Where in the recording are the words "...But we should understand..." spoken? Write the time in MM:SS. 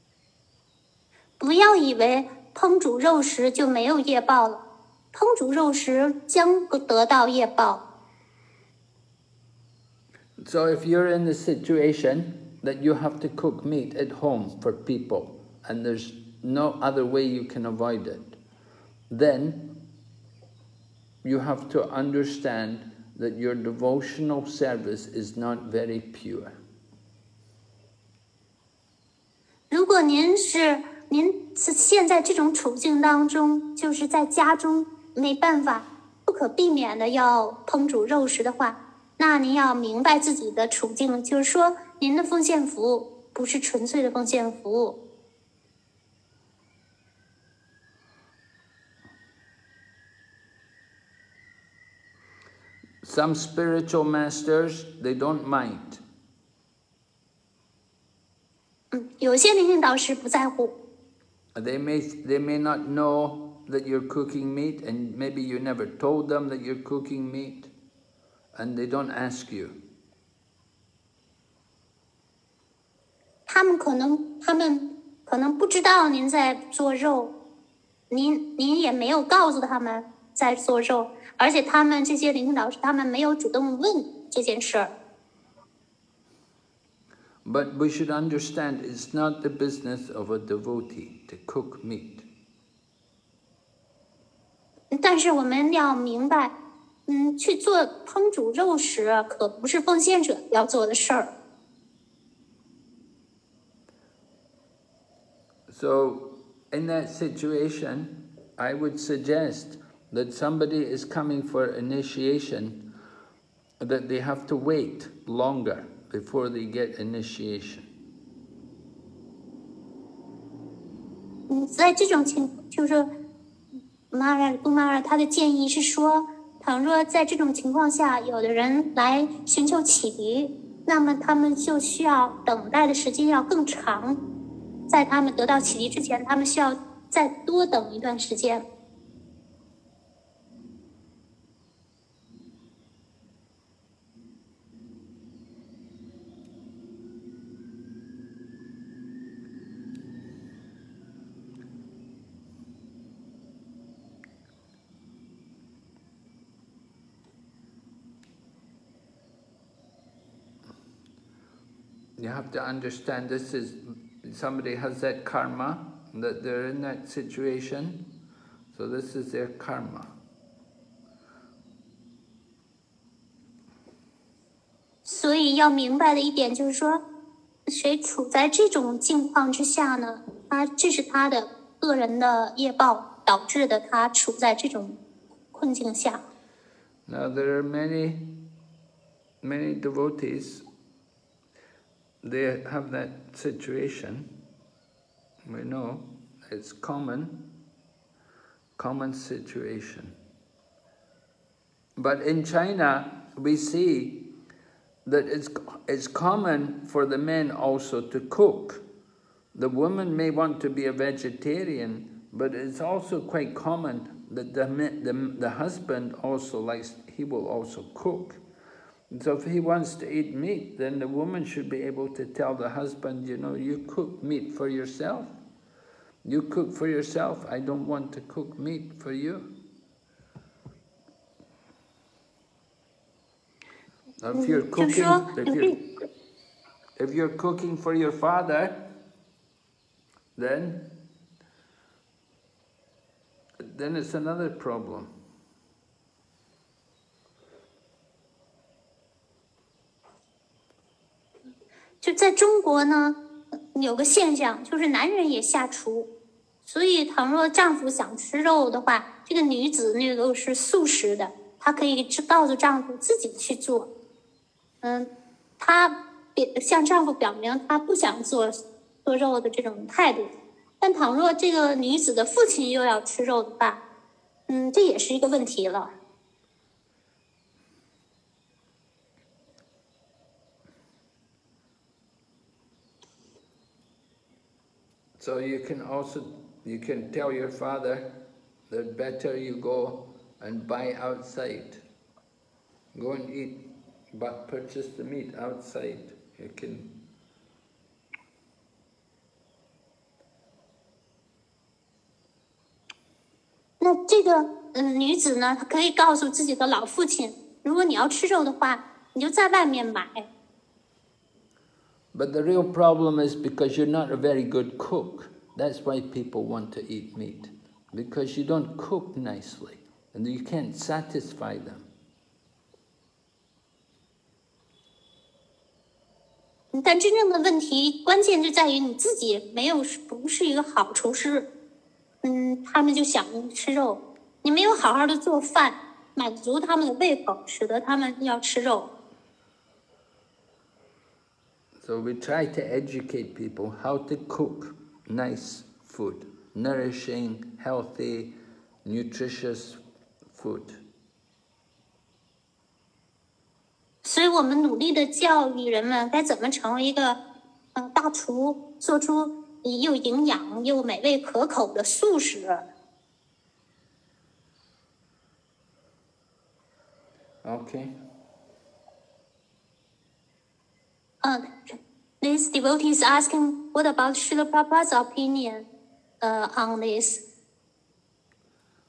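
01:27.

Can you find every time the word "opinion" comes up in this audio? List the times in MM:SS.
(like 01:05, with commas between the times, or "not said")
06:14.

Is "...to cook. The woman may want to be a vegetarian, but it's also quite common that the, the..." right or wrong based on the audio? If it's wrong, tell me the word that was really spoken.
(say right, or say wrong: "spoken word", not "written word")
right.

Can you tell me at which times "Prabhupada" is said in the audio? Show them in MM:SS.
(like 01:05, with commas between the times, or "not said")
06:14.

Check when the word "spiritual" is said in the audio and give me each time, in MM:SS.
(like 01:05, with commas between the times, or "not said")
00:53.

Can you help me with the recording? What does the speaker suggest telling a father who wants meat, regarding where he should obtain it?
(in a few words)
buy outside.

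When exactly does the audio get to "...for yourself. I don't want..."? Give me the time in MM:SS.
03:46.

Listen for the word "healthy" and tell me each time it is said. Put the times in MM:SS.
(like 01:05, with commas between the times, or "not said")
05:47.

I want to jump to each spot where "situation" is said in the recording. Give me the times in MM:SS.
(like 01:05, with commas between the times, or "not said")
00:11, 01:47, 02:47, 03:13, 03:19.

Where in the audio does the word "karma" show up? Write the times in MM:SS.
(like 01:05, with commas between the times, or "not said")
02:45, 02:49.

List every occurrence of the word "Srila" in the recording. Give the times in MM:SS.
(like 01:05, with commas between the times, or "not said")
06:14.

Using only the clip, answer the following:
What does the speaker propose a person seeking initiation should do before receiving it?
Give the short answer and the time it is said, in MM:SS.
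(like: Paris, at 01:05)
wait longer, at 01:54.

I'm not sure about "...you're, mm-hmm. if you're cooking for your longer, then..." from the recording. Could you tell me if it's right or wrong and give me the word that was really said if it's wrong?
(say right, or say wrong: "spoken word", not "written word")
wrong: "father", not "longer".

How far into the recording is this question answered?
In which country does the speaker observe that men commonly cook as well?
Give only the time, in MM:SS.
03:22.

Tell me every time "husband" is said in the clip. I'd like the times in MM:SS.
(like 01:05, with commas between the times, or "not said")
03:35, 03:42.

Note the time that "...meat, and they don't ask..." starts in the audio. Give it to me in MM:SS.
01:07.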